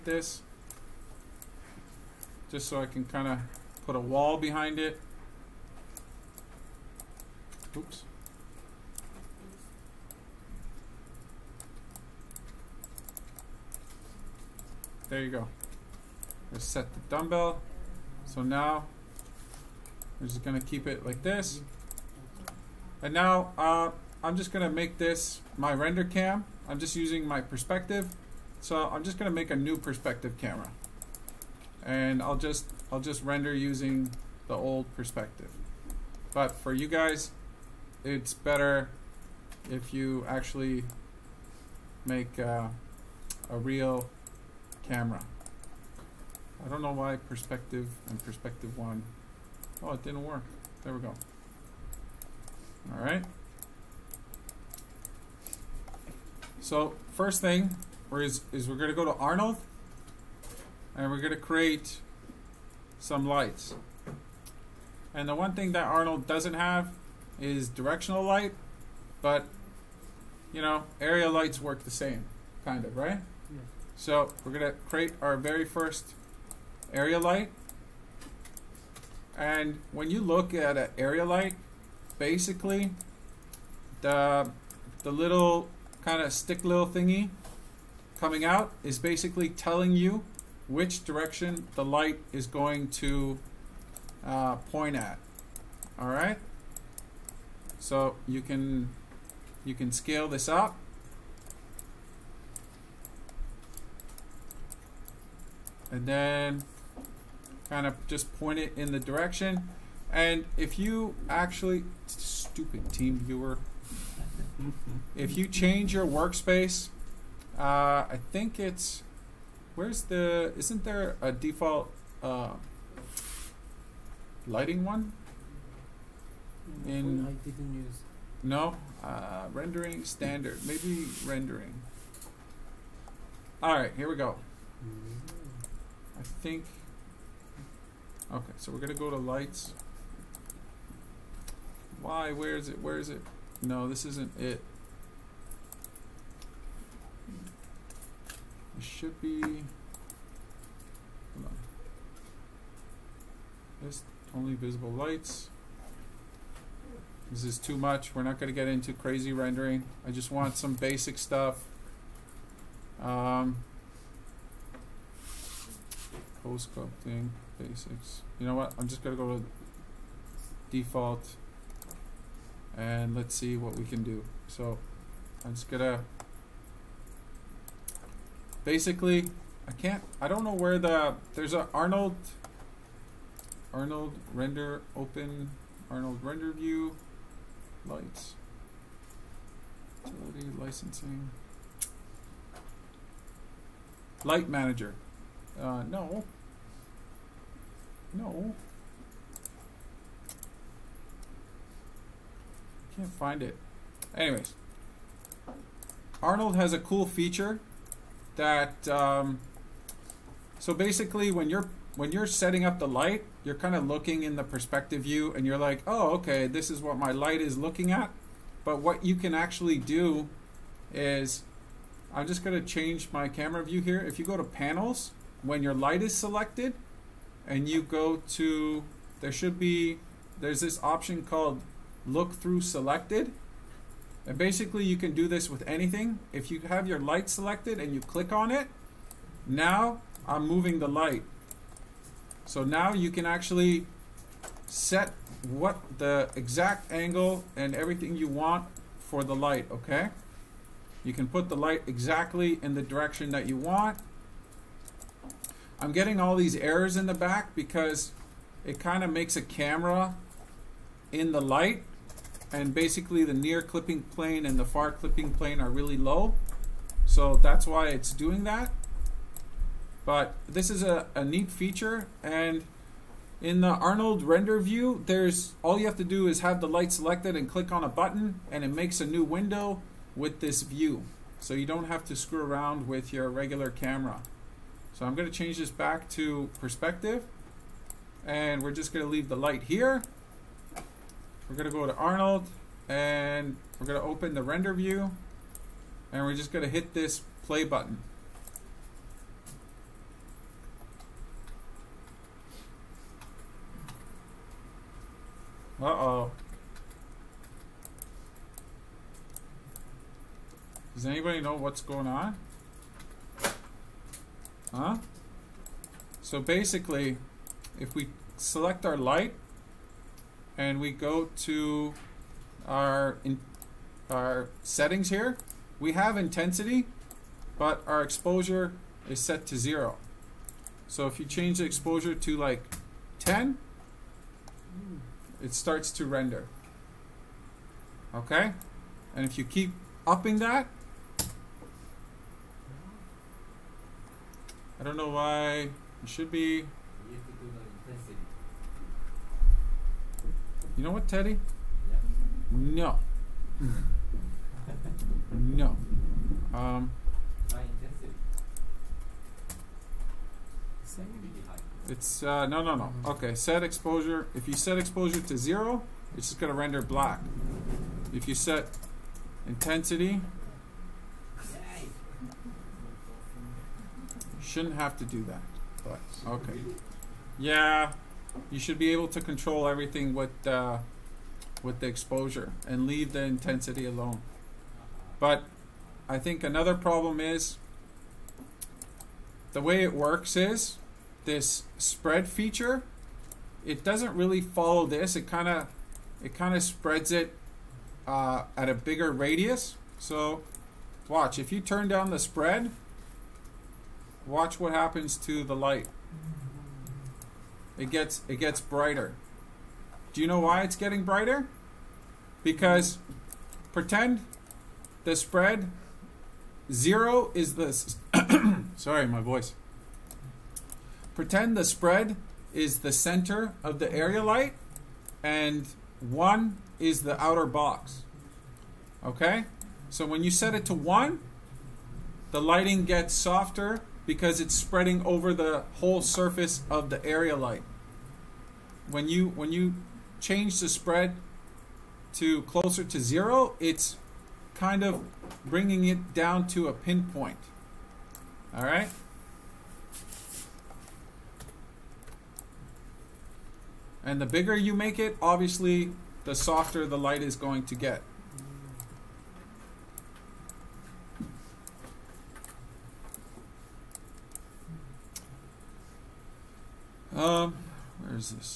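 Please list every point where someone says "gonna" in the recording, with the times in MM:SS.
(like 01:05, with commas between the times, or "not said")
00:20, 00:24, 00:29, 02:18, 02:49, 02:55.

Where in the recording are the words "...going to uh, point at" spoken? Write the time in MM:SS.
01:32.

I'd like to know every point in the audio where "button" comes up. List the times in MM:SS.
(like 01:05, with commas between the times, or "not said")
04:37, 04:57.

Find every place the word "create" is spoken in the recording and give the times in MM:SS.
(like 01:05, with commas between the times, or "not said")
01:01, 01:14.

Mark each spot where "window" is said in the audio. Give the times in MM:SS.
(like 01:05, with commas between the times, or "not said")
04:39.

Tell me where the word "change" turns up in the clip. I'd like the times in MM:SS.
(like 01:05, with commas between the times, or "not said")
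01:55, 03:42, 04:45, 05:31, 07:20.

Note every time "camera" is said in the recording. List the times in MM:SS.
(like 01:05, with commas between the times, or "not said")
00:30, 00:44, 03:43, 04:19, 04:43.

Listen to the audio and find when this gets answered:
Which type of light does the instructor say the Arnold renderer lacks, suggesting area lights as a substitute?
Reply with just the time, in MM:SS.
01:07.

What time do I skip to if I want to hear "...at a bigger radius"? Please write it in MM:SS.
06:38.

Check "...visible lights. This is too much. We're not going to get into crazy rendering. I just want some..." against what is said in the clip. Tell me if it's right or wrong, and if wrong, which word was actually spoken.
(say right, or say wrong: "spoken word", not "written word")
right.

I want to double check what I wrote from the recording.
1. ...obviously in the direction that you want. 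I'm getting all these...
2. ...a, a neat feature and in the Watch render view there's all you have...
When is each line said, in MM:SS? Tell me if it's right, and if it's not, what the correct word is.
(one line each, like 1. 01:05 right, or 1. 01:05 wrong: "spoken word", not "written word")
1. 04:11 wrong: "exactly", not "obviously"
2. 04:30 wrong: "Arnold", not "Watch".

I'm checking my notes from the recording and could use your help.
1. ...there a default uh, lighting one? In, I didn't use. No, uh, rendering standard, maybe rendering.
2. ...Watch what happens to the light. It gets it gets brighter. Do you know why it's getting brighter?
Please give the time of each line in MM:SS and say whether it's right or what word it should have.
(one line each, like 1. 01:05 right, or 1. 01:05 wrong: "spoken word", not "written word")
1. 02:00 right
2. 06:44 right.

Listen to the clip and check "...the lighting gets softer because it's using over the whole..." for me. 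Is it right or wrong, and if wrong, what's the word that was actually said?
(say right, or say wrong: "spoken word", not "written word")
wrong: "spreading", not "using".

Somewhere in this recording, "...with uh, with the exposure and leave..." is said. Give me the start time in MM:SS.
06:20.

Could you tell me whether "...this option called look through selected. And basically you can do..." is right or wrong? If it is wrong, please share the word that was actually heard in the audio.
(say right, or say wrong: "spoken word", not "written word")
right.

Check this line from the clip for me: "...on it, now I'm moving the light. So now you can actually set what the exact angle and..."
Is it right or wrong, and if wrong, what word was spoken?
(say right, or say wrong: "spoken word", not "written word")
right.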